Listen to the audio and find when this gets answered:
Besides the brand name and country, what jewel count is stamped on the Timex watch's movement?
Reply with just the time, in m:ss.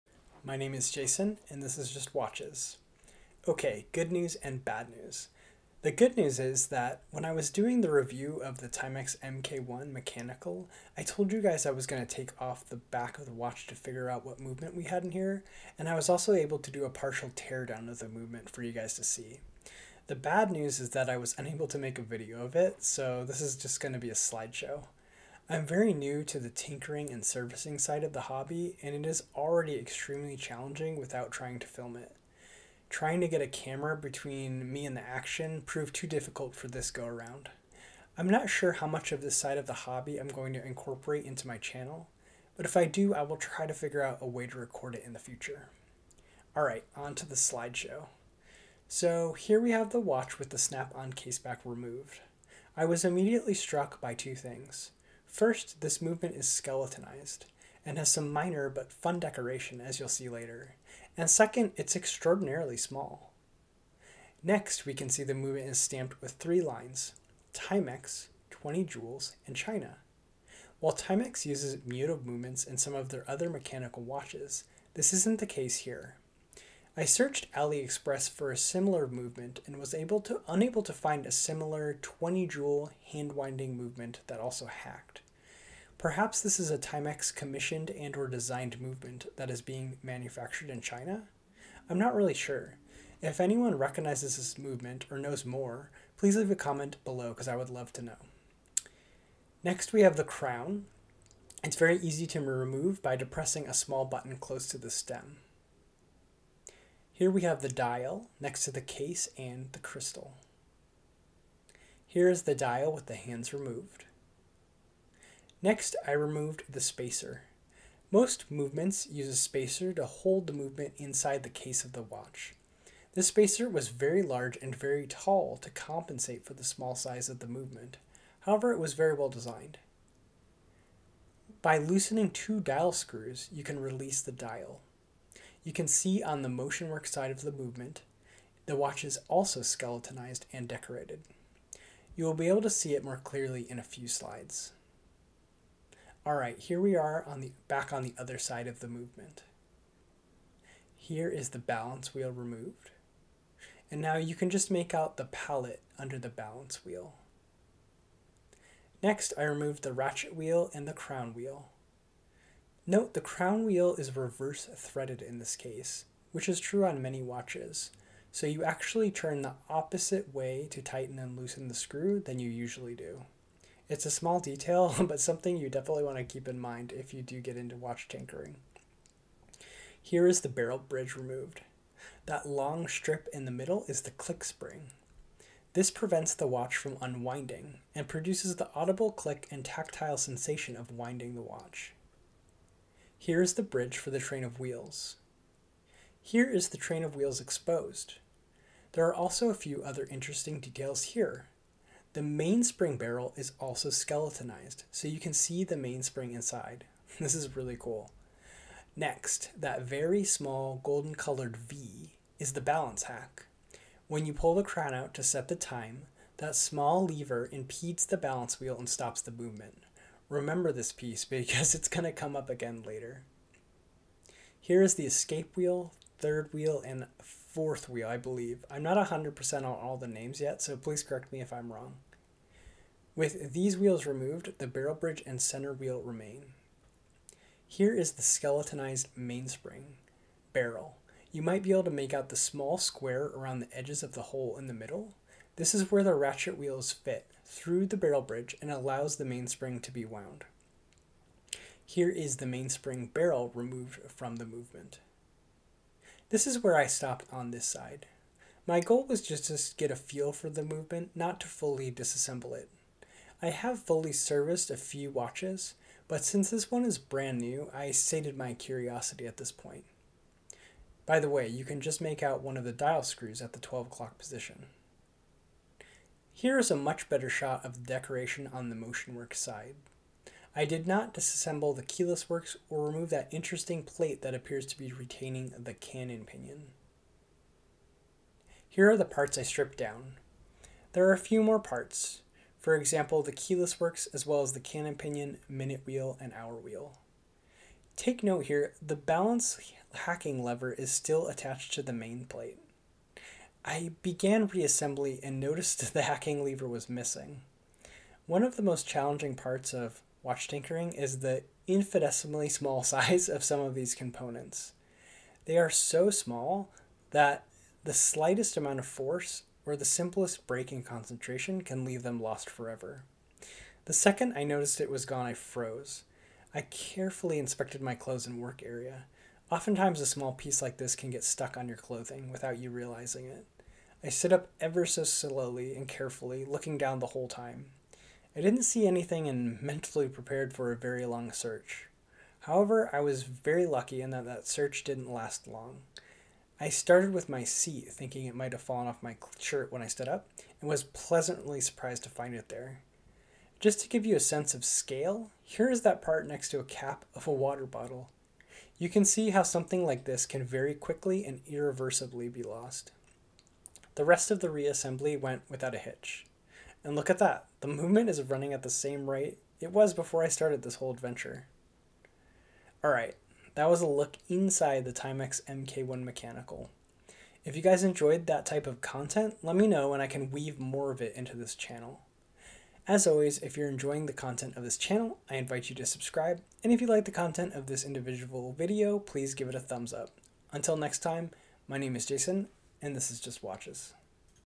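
1:08.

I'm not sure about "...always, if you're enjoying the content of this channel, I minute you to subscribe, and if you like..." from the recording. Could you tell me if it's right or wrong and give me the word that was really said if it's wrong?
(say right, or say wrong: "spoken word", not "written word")
wrong: "invite", not "minute".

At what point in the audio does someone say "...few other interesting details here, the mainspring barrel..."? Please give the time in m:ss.
3:19.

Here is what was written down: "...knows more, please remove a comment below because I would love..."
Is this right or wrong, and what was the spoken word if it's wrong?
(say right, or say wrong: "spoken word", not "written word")
wrong: "leave", not "remove".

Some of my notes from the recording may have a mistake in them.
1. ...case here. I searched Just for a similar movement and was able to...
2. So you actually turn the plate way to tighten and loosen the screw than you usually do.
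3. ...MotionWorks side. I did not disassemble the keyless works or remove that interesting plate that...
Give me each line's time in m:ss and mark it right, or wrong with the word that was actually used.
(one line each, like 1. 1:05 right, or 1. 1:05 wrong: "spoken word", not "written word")
1. 1:15 wrong: "AliExpress", not "Just"
2. 2:48 wrong: "opposite", not "plate"
3. 4:38 right.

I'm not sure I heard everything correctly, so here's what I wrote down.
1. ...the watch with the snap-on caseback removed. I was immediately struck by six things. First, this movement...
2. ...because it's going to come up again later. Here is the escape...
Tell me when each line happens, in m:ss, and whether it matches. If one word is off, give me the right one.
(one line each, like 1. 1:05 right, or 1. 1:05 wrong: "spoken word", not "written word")
1. 0:49 wrong: "two", not "six"
2. 3:41 right.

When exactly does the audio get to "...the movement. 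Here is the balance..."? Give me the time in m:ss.
2:28.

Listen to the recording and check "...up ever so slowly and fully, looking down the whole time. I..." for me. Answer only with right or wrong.
wrong.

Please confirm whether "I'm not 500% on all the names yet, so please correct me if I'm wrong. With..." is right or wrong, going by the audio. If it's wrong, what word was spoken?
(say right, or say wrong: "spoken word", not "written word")
wrong: "100", not "500".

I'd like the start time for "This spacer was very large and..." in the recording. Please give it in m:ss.
2:03.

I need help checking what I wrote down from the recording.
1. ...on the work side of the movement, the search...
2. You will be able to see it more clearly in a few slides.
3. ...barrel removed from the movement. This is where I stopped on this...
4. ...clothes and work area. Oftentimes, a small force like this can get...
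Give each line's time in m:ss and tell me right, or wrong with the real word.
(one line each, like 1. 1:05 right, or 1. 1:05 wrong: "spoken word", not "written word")
1. 2:16 wrong: "watch", not "search"
2. 2:22 right
3. 4:13 right
4. 5:27 wrong: "piece", not "force".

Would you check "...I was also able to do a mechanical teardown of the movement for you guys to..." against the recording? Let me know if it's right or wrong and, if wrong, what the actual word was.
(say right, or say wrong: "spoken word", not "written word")
wrong: "partial", not "mechanical".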